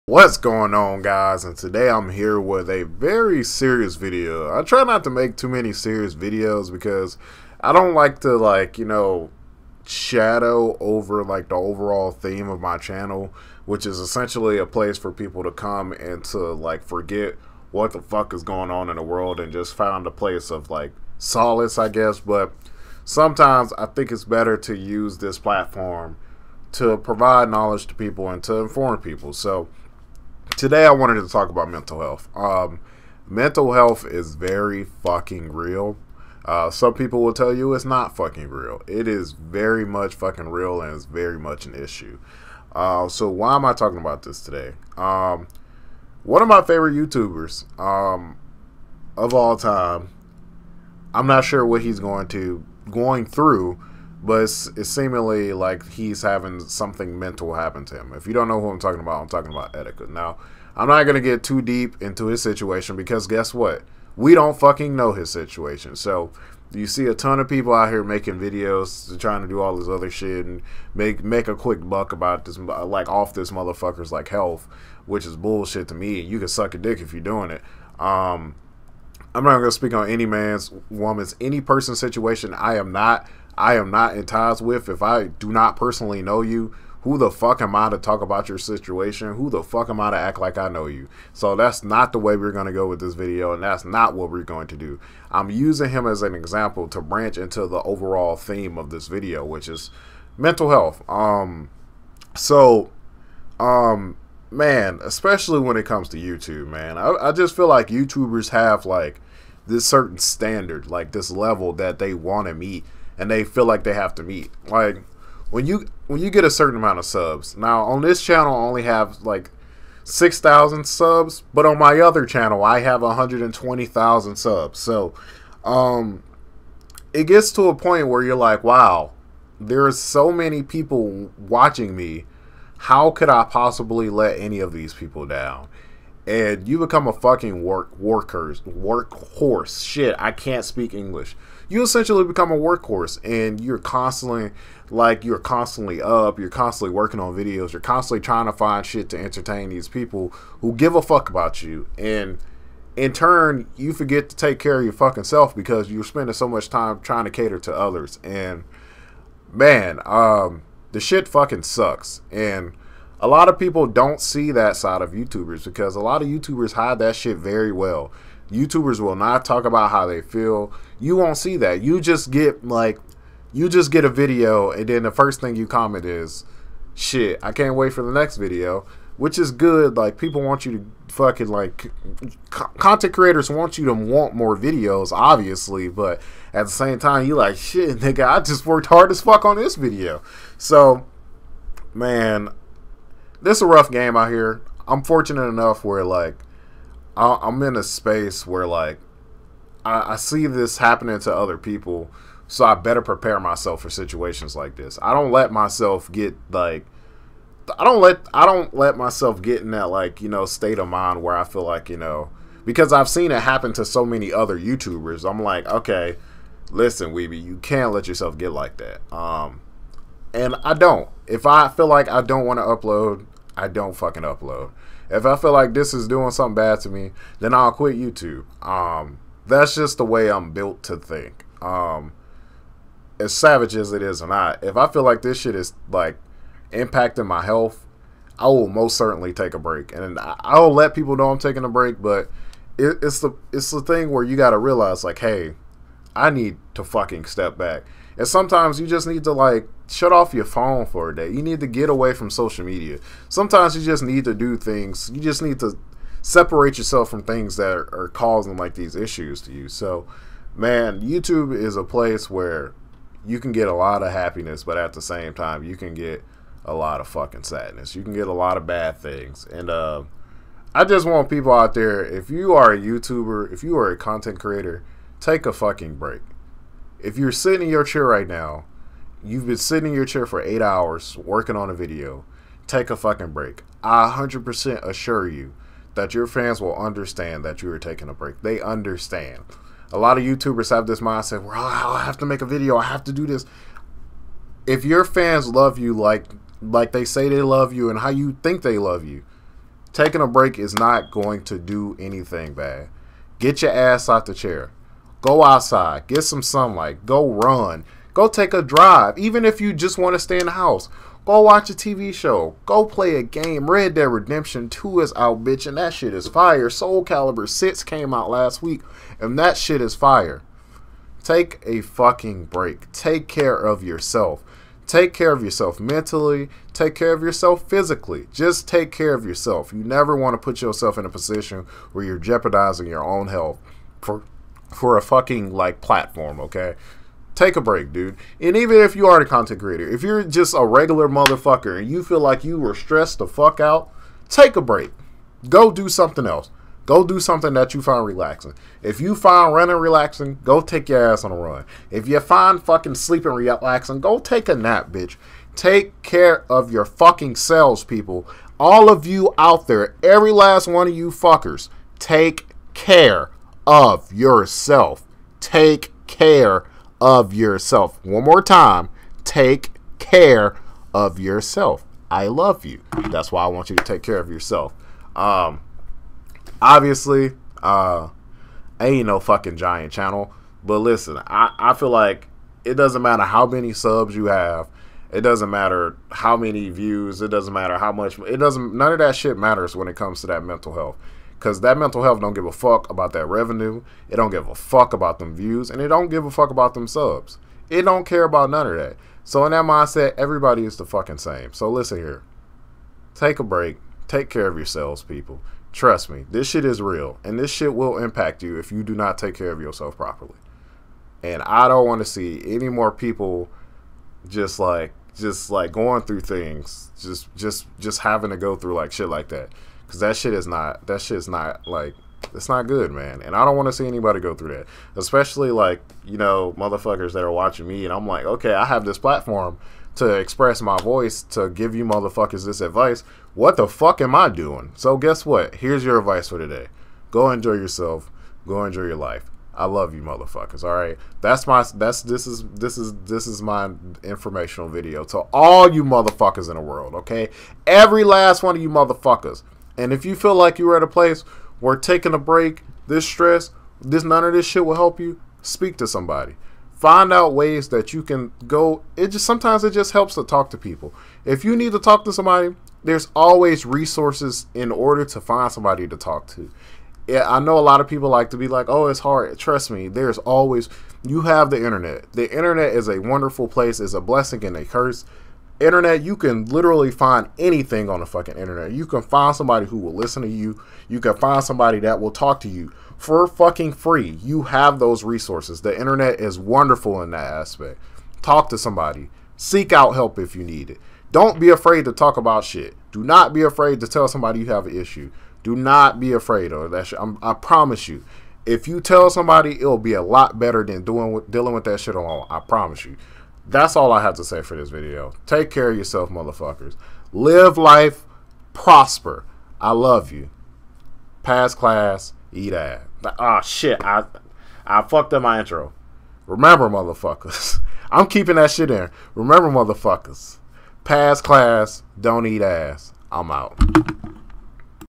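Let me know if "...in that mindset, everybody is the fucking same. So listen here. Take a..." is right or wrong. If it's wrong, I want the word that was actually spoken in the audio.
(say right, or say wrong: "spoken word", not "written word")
right.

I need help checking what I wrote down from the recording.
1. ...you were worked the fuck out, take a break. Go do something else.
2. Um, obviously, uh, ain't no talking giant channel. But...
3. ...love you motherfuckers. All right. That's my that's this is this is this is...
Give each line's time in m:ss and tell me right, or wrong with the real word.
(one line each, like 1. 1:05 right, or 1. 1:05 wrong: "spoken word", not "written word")
1. 5:42 wrong: "stressed", not "worked"
2. 6:15 wrong: "fucking", not "talking"
3. 7:19 right.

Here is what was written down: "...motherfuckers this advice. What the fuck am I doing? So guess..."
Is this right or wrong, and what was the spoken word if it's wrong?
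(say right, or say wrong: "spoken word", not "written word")
right.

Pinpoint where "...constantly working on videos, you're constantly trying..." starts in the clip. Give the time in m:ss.
2:26.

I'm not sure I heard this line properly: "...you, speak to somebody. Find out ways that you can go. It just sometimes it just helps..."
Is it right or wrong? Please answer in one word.
right.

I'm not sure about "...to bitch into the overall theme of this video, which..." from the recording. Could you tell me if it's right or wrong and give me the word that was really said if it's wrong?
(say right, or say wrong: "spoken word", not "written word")
wrong: "branch", not "bitch".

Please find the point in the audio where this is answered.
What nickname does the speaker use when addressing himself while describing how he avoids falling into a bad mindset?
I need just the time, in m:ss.
3:37.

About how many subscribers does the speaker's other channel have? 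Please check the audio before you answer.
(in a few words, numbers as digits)
120,000.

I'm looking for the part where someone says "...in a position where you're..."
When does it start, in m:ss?
5:30.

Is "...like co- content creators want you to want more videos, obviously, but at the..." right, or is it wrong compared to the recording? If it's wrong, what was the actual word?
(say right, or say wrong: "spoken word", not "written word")
right.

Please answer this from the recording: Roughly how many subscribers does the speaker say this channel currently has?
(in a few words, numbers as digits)
6,000.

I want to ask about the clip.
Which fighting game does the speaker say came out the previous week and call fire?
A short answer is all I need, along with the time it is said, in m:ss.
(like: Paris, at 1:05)
Soul Calibur 6, at 5:16.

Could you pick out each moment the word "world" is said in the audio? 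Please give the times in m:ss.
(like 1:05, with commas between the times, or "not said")
0:19, 7:26.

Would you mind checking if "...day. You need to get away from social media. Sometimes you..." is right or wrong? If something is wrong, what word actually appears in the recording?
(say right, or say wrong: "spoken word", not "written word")
right.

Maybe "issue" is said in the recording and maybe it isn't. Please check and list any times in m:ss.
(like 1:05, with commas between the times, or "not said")
0:41, 4:18, 8:14.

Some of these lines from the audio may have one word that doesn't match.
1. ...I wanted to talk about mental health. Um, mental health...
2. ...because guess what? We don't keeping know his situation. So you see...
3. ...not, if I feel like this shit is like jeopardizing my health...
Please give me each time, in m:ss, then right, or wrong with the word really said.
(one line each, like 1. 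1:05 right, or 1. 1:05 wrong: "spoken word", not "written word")
1. 0:30 right
2. 1:02 wrong: "fucking", not "keeping"
3. 3:54 wrong: "impacting", not "jeopardizing".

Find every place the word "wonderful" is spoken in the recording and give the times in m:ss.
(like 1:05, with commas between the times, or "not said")
7:52, 8:06.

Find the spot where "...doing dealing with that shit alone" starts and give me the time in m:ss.
8:20.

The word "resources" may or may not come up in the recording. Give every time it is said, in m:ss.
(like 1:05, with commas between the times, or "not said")
7:43, 8:05.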